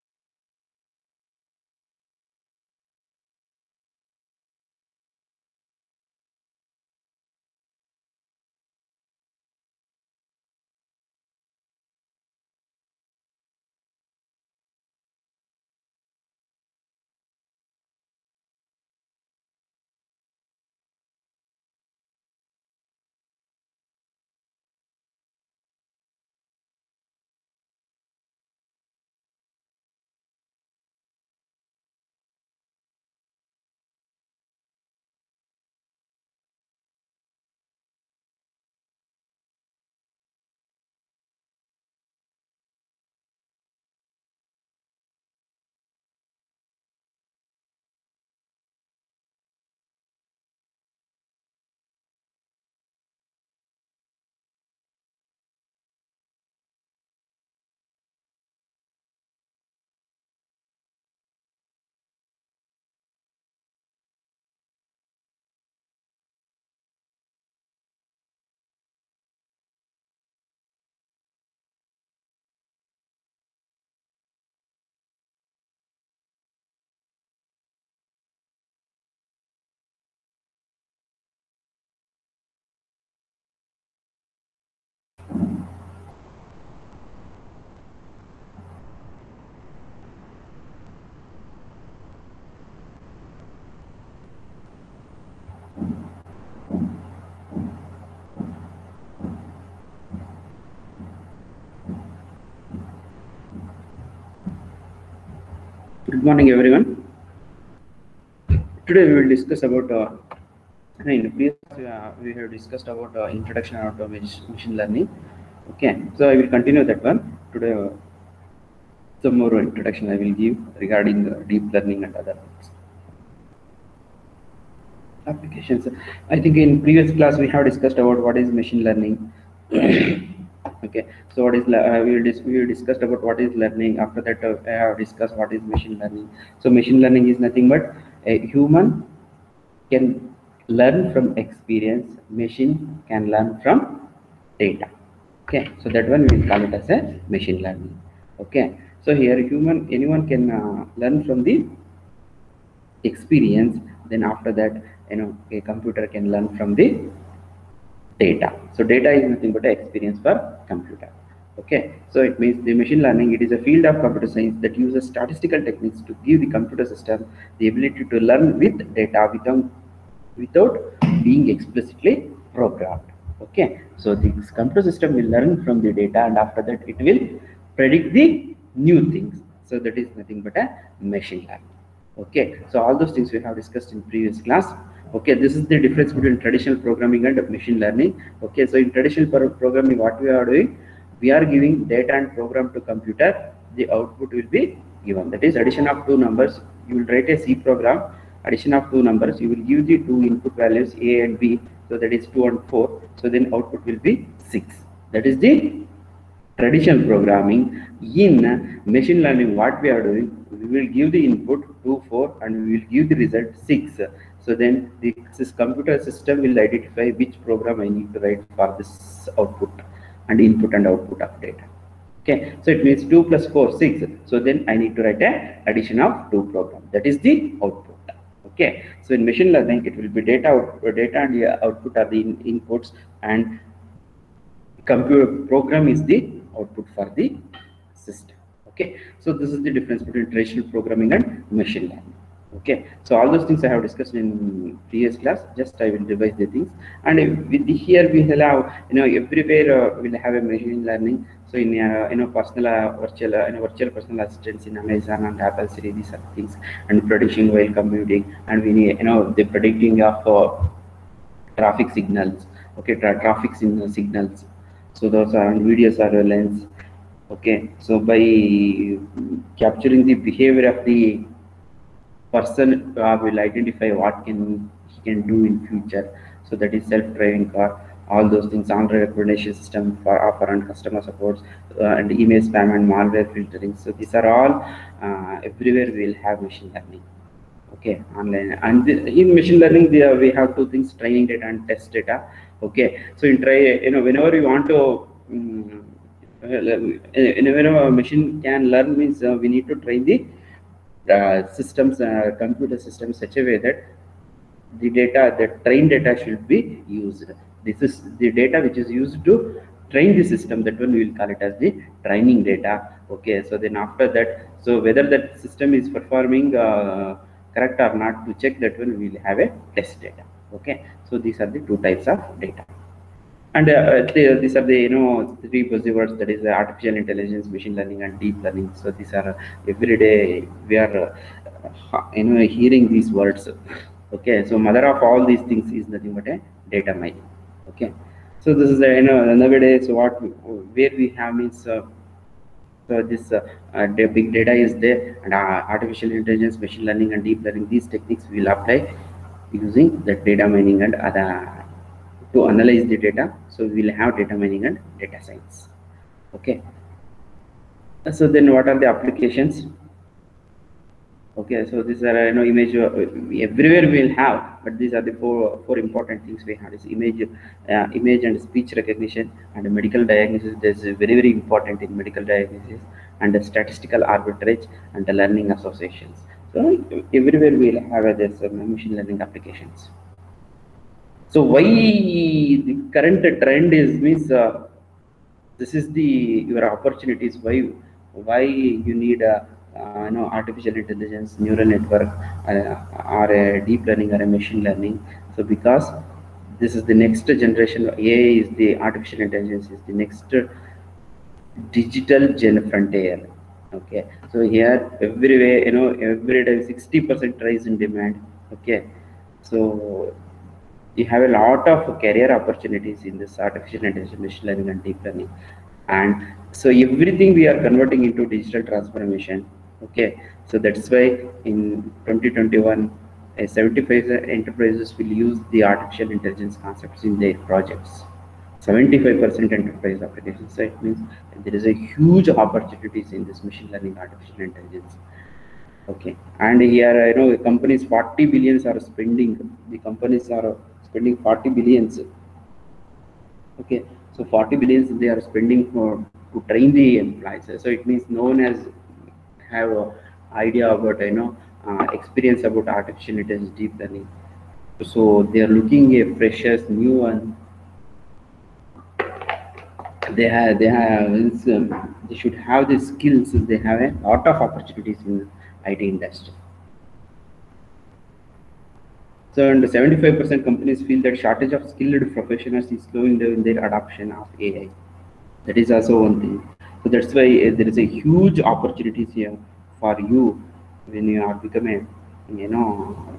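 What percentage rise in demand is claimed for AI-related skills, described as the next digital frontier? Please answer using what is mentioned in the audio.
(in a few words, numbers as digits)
60%.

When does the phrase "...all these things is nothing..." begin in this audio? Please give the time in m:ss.
5:35.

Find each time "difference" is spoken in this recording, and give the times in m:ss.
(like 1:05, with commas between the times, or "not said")
3:05, 3:59.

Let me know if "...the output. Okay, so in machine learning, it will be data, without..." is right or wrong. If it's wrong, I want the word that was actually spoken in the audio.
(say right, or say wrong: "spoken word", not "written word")
wrong: "output", not "without".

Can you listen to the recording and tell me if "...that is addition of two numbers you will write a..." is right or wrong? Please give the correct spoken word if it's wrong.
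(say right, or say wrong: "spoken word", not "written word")
right.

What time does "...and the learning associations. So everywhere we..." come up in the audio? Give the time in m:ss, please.
6:14.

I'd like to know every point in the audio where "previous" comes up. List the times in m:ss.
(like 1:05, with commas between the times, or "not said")
1:51, 2:06, 3:04, 4:04.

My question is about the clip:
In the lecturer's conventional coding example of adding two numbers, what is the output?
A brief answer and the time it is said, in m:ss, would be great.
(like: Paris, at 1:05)
6, at 3:23.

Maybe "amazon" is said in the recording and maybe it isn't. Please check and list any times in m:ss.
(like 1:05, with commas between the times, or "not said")
4:14.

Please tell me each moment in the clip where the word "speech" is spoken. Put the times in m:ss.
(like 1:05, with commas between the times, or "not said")
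6:08.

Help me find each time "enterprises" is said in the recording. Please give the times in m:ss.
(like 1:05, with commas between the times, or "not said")
7:04, 7:09.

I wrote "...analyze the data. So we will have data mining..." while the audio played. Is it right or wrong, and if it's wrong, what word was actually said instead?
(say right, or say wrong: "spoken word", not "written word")
right.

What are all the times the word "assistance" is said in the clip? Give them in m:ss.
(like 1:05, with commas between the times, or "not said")
4:14.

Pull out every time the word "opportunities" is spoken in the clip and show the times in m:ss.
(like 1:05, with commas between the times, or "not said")
6:26, 6:52, 7:12, 7:44, 7:58.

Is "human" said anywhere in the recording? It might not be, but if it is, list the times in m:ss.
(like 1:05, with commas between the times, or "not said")
2:18, 2:29.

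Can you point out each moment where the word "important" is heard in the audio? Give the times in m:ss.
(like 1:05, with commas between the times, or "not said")
6:05, 6:11.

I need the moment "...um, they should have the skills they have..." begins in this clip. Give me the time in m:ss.
7:41.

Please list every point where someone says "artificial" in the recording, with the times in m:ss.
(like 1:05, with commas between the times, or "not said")
5:26, 5:45, 6:30, 6:38, 6:53, 7:05, 7:13, 7:32.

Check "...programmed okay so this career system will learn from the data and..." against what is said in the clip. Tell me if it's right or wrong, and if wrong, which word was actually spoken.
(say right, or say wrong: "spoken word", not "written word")
wrong: "computer", not "career".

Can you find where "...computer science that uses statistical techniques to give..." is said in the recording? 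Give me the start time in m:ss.
2:44.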